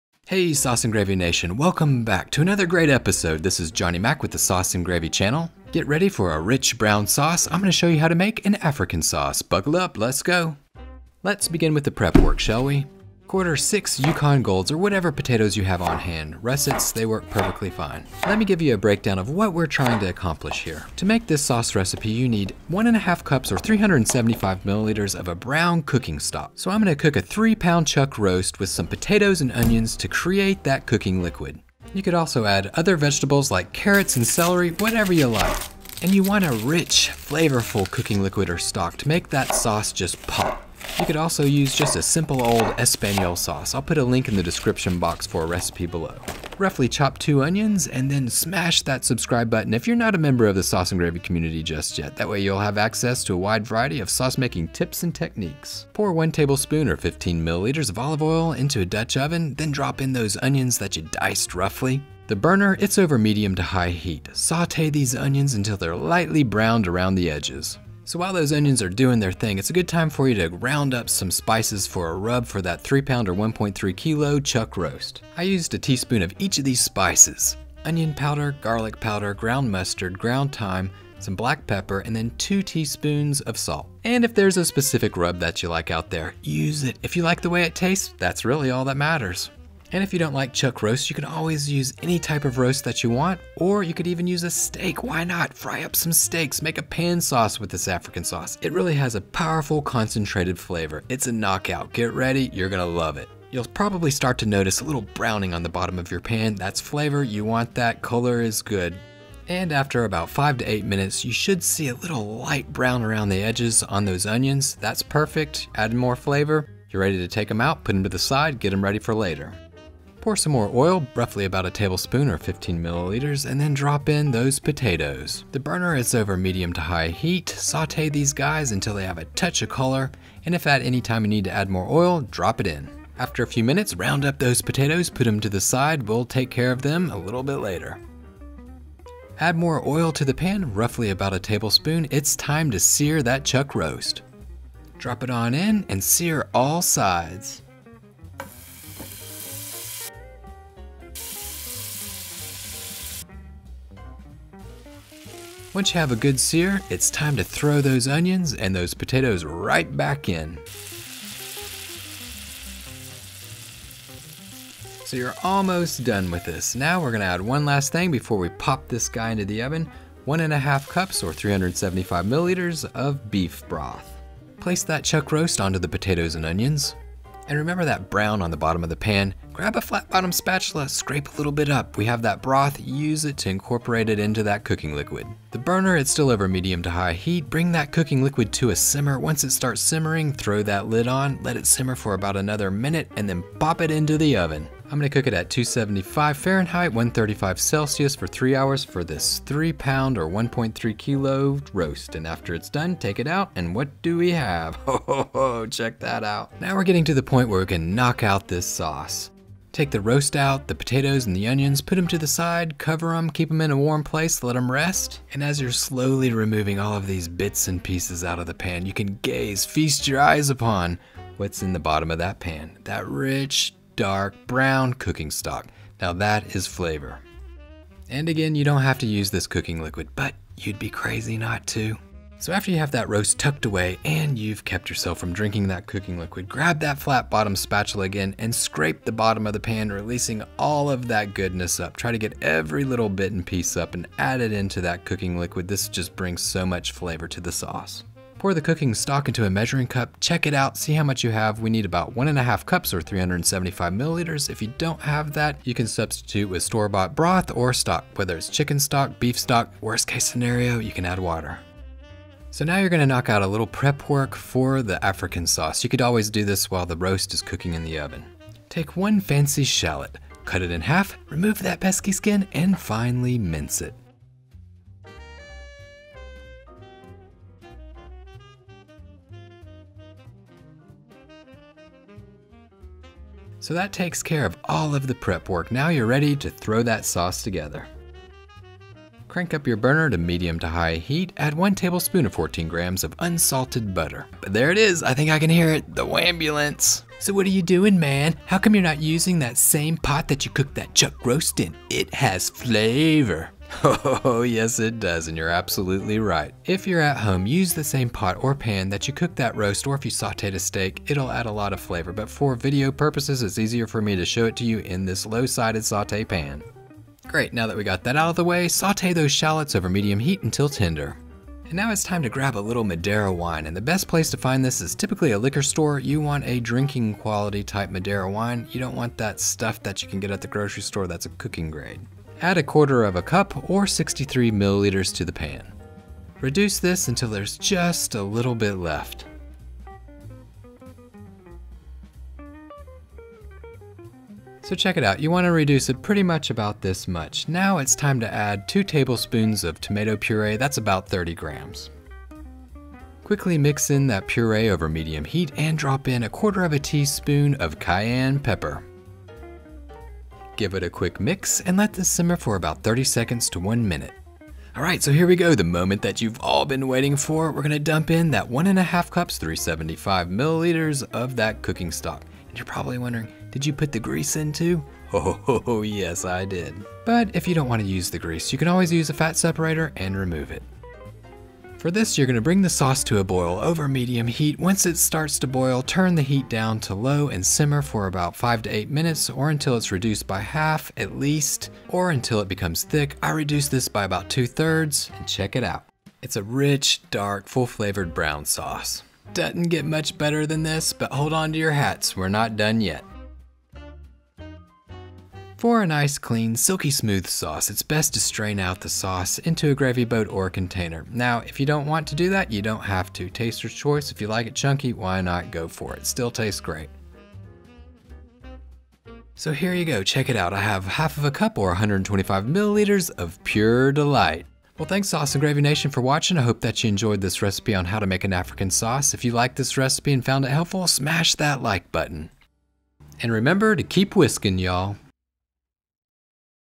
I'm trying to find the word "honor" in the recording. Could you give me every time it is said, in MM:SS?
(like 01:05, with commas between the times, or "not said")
not said.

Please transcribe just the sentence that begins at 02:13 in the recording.
After a few minutes, round up those potatoes, put them to the side.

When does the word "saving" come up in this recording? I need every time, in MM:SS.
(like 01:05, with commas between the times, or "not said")
not said.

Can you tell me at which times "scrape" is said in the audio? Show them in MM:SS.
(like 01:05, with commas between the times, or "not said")
03:00, 03:58.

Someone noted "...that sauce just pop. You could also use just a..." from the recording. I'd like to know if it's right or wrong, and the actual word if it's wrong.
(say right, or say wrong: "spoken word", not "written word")
right.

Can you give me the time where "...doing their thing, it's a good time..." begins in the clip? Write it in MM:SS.
01:08.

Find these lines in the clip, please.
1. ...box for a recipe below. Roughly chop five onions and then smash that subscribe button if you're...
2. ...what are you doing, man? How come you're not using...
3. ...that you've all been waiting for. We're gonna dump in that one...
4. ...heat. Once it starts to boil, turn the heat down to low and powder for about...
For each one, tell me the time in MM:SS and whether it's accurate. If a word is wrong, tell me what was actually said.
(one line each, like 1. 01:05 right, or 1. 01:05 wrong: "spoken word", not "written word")
1. 00:44 wrong: "two", not "five"
2. 04:57 right
3. 06:06 right
4. 06:24 wrong: "simmer", not "powder".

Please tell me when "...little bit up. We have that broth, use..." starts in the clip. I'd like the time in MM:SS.
03:01.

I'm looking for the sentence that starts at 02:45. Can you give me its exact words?
So you're almost done with this.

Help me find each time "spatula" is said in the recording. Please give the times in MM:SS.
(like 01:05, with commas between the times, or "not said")
03:00, 03:57.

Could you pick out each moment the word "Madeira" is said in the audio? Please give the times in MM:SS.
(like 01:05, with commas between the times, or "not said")
05:22, 05:27.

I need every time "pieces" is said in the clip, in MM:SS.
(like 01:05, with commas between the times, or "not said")
03:37, 04:03.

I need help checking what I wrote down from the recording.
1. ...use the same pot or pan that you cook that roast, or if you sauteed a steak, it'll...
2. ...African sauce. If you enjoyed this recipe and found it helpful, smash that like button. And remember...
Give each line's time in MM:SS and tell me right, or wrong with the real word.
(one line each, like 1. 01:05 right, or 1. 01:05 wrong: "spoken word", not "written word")
1. 05:07 right
2. 07:08 wrong: "liked", not "enjoyed".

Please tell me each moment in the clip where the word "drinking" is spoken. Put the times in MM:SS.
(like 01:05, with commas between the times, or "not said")
03:55, 05:26.